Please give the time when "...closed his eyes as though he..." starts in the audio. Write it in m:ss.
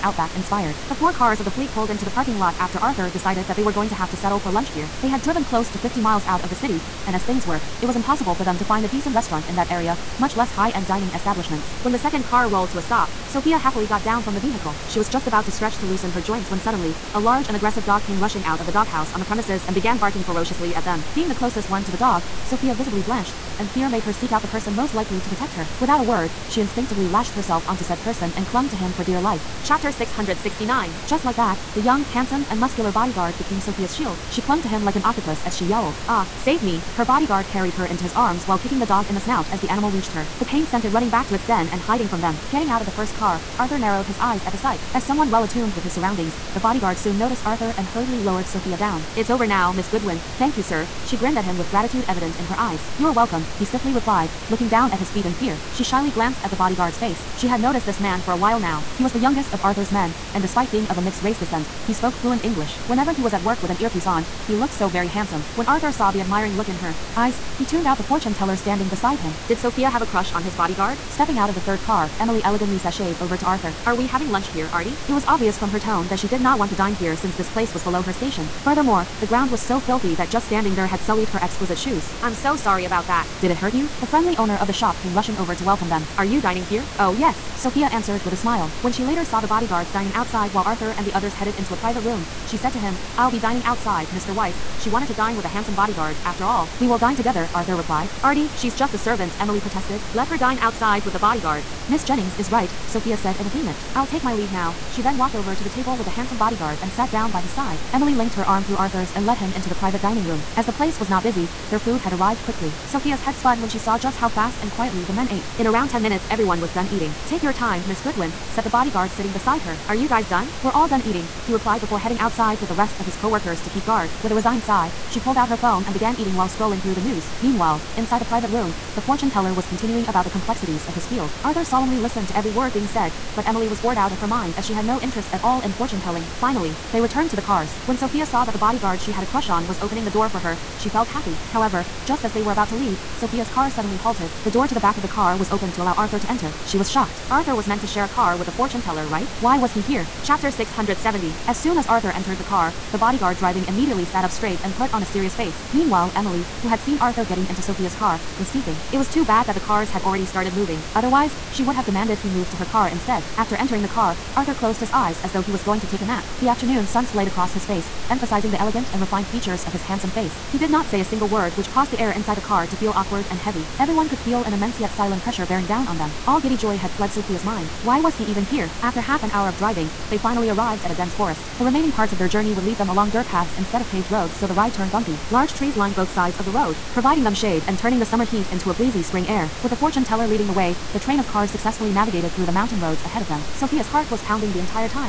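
2:44.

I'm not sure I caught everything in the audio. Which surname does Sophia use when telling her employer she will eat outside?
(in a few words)
Weiss.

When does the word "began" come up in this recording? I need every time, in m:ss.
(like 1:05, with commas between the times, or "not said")
0:19, 2:05.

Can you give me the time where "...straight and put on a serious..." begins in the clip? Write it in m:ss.
2:34.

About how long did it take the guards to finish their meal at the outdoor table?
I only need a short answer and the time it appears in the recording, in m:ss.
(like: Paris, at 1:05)
10 minutes, at 1:55.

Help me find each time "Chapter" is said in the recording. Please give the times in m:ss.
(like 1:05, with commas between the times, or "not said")
0:29, 2:30.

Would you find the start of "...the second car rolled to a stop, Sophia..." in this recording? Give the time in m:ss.
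0:11.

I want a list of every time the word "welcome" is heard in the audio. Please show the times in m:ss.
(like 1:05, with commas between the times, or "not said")
0:53, 1:25.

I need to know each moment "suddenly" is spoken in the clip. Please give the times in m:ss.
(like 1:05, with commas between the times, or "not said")
0:16, 2:23.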